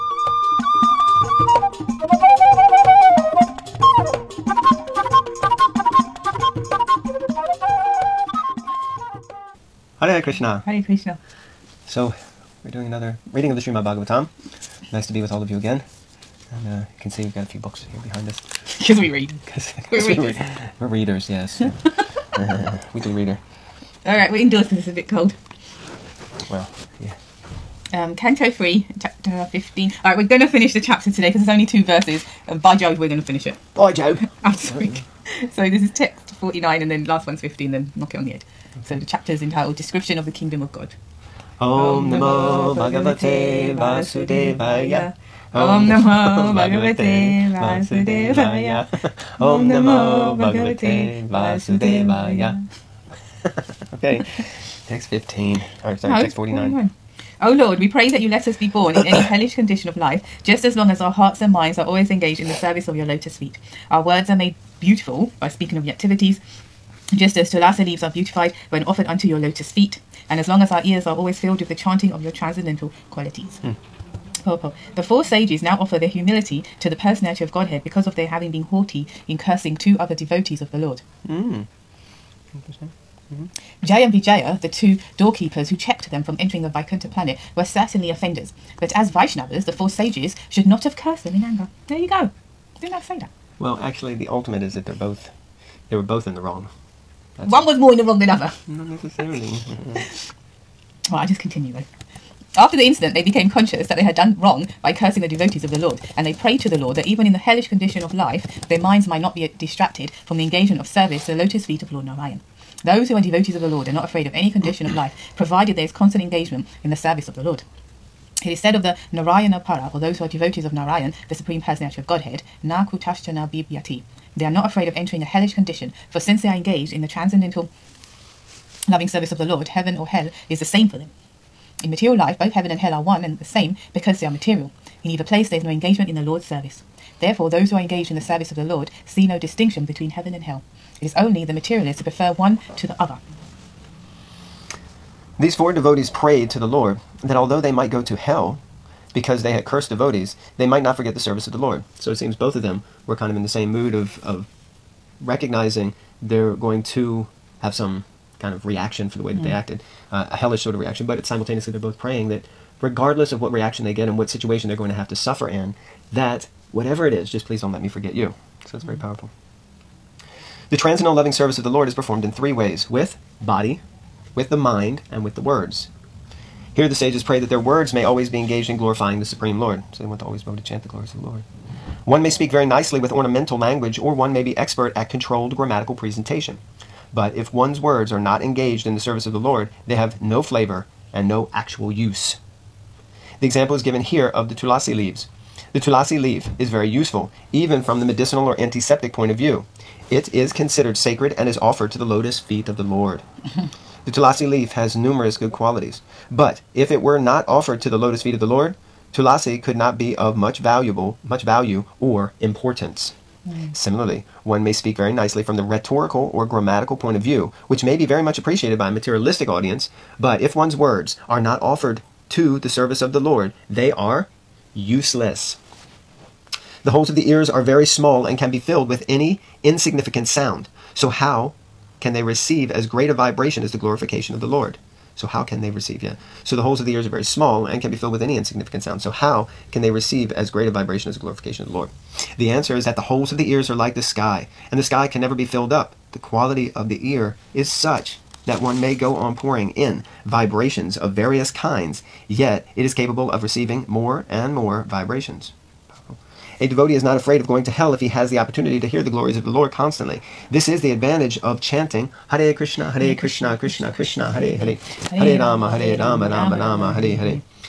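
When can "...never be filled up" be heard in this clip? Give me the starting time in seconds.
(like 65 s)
245 s.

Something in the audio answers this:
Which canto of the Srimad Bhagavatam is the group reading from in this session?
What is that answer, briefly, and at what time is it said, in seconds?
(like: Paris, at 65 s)
Canto 3, at 28 s.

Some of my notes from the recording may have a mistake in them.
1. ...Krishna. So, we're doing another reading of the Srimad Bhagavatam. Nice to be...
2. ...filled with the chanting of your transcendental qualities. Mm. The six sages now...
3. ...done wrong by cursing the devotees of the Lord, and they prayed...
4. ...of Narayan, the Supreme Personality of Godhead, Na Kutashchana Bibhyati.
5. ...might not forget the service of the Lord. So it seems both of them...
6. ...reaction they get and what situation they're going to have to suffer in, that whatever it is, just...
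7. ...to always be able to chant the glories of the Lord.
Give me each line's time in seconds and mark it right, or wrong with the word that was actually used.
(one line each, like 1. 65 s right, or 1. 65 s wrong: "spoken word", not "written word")
1. 10 s right
2. 71 s wrong: "four", not "six"
3. 104 s right
4. 120 s right
5. 150 s right
6. 163 s right
7. 180 s right.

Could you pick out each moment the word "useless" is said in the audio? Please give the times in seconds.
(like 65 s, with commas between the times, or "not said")
224 s.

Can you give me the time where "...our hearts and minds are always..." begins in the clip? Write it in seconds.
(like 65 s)
61 s.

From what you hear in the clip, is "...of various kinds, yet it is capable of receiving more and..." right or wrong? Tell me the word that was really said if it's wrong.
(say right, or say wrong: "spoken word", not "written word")
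right.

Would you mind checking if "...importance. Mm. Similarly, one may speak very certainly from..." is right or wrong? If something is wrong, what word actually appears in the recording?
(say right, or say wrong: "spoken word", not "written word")
wrong: "nicely", not "certainly".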